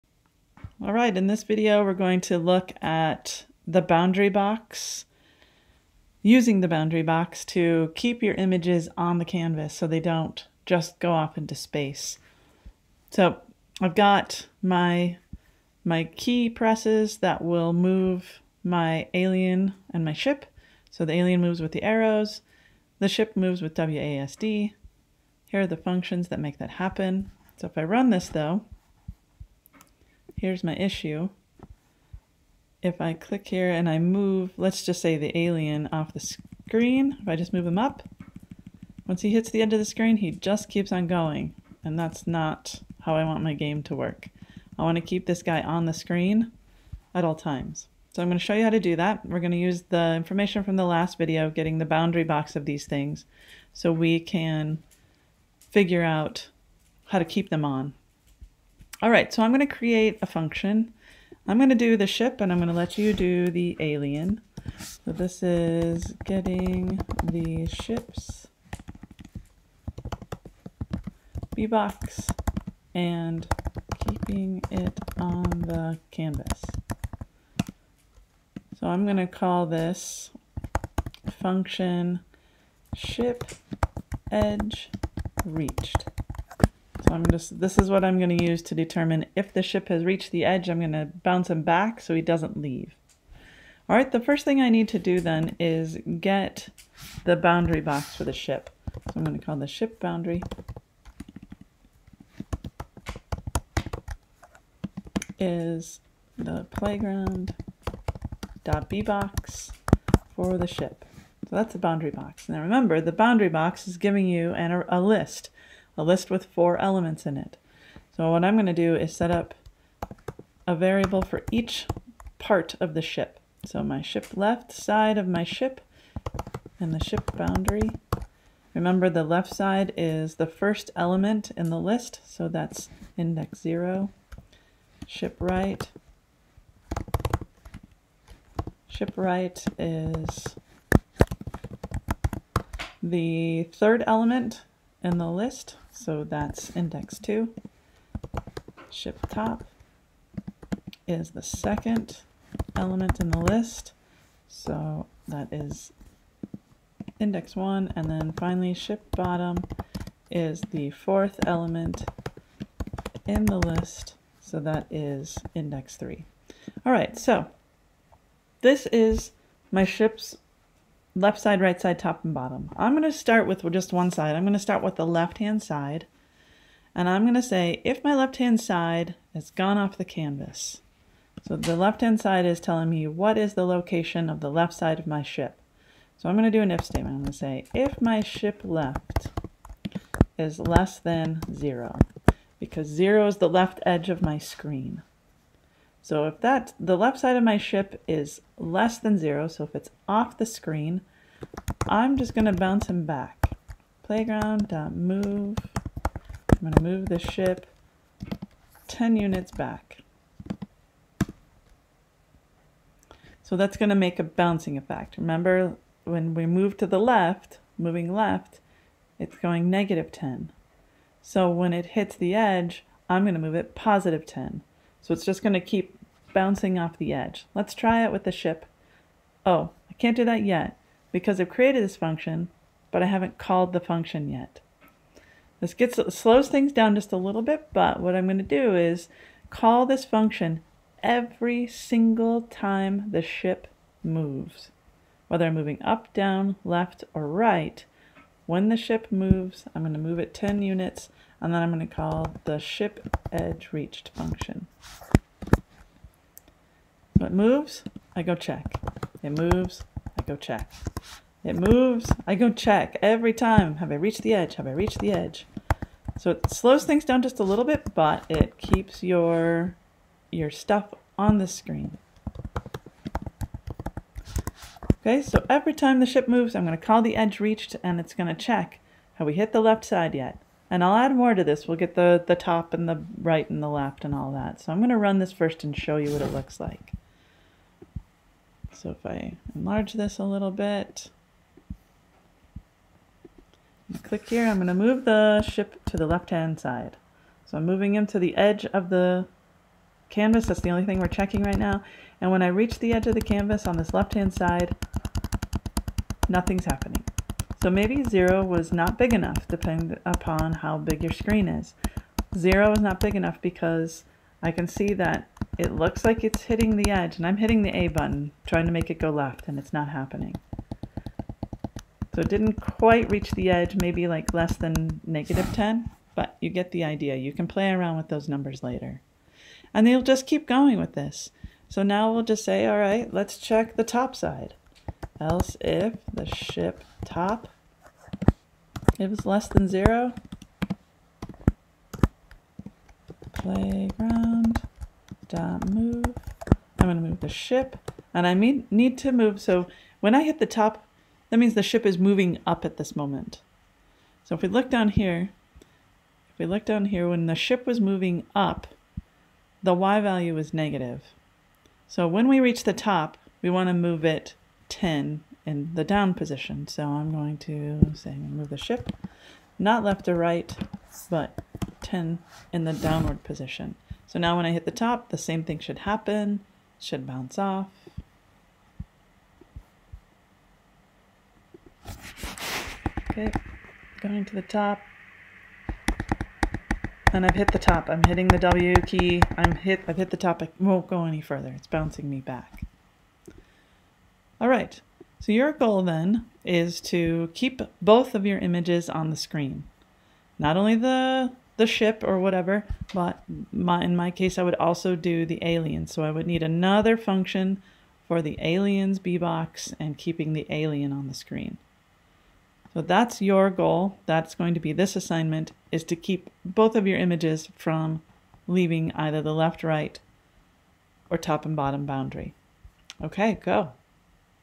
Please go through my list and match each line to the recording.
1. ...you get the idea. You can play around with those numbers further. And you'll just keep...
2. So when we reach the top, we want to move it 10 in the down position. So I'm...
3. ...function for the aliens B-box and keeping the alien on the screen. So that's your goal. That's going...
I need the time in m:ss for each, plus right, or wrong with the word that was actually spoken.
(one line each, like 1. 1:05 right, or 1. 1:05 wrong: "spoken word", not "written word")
1. 5:26 wrong: "later", not "further"
2. 6:01 right
3. 6:46 right.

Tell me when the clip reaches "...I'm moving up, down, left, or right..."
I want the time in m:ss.
4:05.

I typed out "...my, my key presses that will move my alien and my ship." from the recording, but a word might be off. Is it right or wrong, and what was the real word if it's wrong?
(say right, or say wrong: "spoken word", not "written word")
right.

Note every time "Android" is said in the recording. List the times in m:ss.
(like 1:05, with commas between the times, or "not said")
not said.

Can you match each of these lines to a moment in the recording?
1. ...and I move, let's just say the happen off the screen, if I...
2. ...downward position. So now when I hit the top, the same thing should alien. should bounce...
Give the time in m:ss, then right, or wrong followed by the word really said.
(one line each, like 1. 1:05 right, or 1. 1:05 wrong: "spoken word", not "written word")
1. 0:33 wrong: "alien", not "happen"
2. 6:12 wrong: "happen", not "alien".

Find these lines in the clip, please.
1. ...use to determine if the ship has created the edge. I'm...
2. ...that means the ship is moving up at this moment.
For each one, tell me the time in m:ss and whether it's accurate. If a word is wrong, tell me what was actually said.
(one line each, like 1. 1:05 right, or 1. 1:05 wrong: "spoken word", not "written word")
1. 1:28 wrong: "reached", not "created"
2. 5:51 right.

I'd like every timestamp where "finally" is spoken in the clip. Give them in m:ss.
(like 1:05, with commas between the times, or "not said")
2:38.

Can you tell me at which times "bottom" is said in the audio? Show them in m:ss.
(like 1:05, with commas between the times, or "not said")
2:39, 2:52, 7:01.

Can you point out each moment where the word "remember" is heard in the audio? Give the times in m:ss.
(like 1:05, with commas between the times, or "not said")
1:52, 2:08, 3:35.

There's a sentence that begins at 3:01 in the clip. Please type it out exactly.
So the left-hand side is telling me what is the location of the left side of my ship.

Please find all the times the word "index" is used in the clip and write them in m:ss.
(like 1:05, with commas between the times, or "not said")
2:13, 2:26, 2:37, 2:45.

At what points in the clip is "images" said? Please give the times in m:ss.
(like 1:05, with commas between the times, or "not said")
0:08, 6:38, 6:56.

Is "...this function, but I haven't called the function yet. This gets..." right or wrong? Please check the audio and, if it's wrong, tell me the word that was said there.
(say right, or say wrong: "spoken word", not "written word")
right.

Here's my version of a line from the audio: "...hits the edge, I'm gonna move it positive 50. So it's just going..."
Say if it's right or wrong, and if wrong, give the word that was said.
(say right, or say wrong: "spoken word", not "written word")
wrong: "10", not "50".